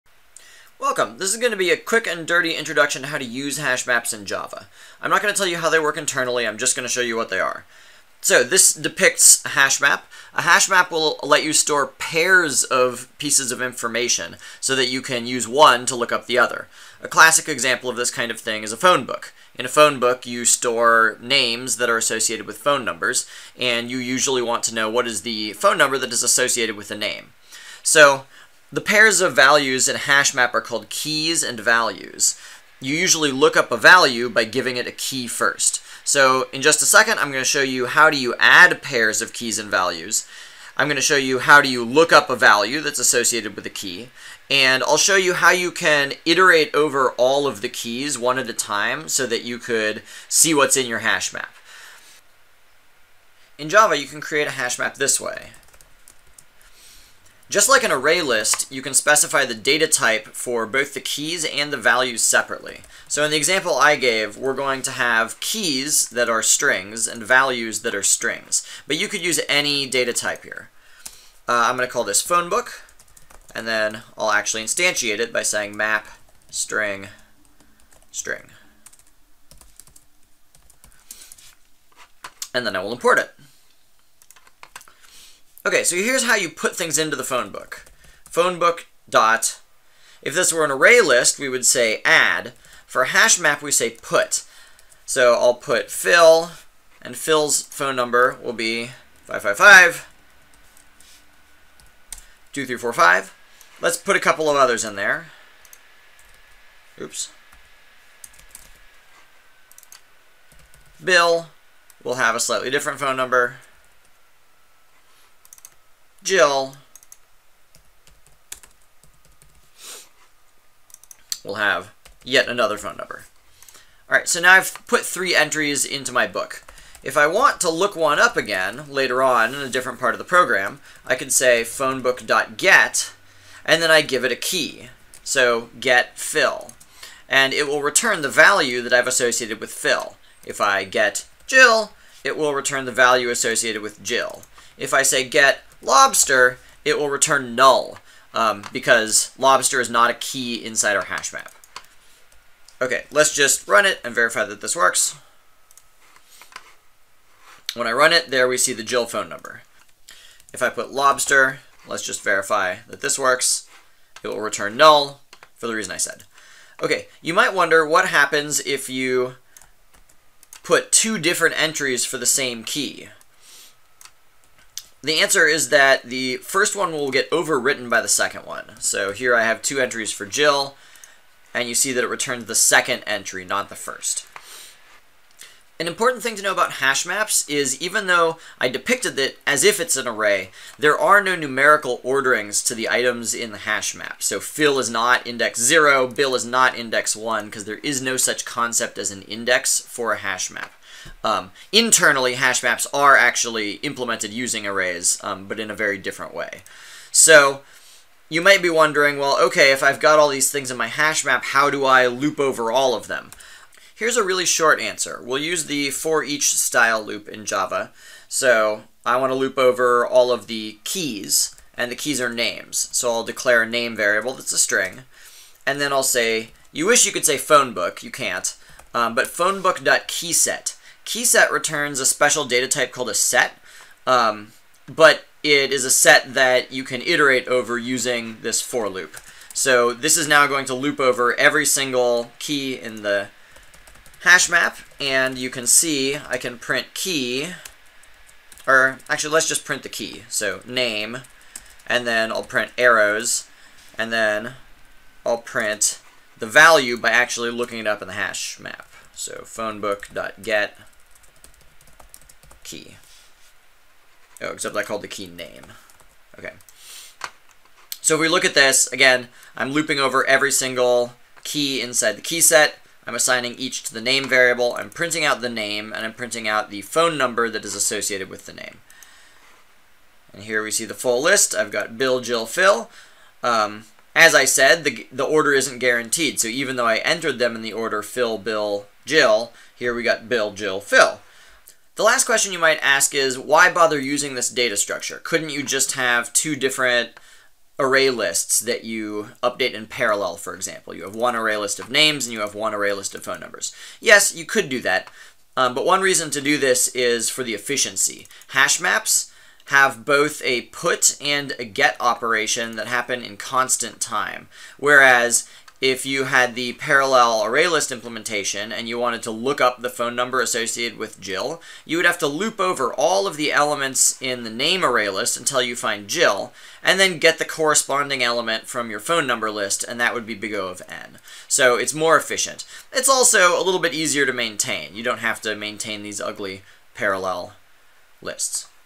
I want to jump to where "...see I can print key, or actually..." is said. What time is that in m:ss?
4:05.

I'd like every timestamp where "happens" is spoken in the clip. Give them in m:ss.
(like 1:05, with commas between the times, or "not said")
2:48, 5:12.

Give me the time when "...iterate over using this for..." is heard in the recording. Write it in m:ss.
3:57.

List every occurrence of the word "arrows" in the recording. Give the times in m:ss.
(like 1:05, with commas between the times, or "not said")
4:12.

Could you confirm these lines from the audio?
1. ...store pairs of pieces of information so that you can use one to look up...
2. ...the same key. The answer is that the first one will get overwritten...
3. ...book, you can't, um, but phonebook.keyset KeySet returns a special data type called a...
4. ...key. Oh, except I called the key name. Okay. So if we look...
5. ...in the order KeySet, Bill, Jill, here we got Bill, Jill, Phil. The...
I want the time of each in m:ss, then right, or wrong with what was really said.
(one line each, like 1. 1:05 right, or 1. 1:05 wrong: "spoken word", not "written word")
1. 0:11 right
2. 2:52 right
3. 3:47 right
4. 4:22 right
5. 4:47 wrong: "Phil", not "KeySet".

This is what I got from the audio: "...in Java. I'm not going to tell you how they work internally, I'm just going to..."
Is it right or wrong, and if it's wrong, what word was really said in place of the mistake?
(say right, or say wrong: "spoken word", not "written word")
right.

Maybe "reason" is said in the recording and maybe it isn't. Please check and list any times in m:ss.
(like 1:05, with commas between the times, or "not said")
2:45, 5:06.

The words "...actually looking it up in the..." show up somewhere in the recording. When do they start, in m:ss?
4:17.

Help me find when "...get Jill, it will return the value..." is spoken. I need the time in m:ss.
2:20.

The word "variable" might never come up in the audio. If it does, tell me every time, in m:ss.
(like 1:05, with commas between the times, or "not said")
3:43, 4:34.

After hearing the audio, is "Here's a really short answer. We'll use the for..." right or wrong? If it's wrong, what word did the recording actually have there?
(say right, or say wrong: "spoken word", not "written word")
right.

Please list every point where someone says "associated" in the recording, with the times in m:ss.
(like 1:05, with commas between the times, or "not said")
0:21, 0:26, 0:42, 2:19, 2:23, 4:37, 5:20.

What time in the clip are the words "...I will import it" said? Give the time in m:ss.
1:22.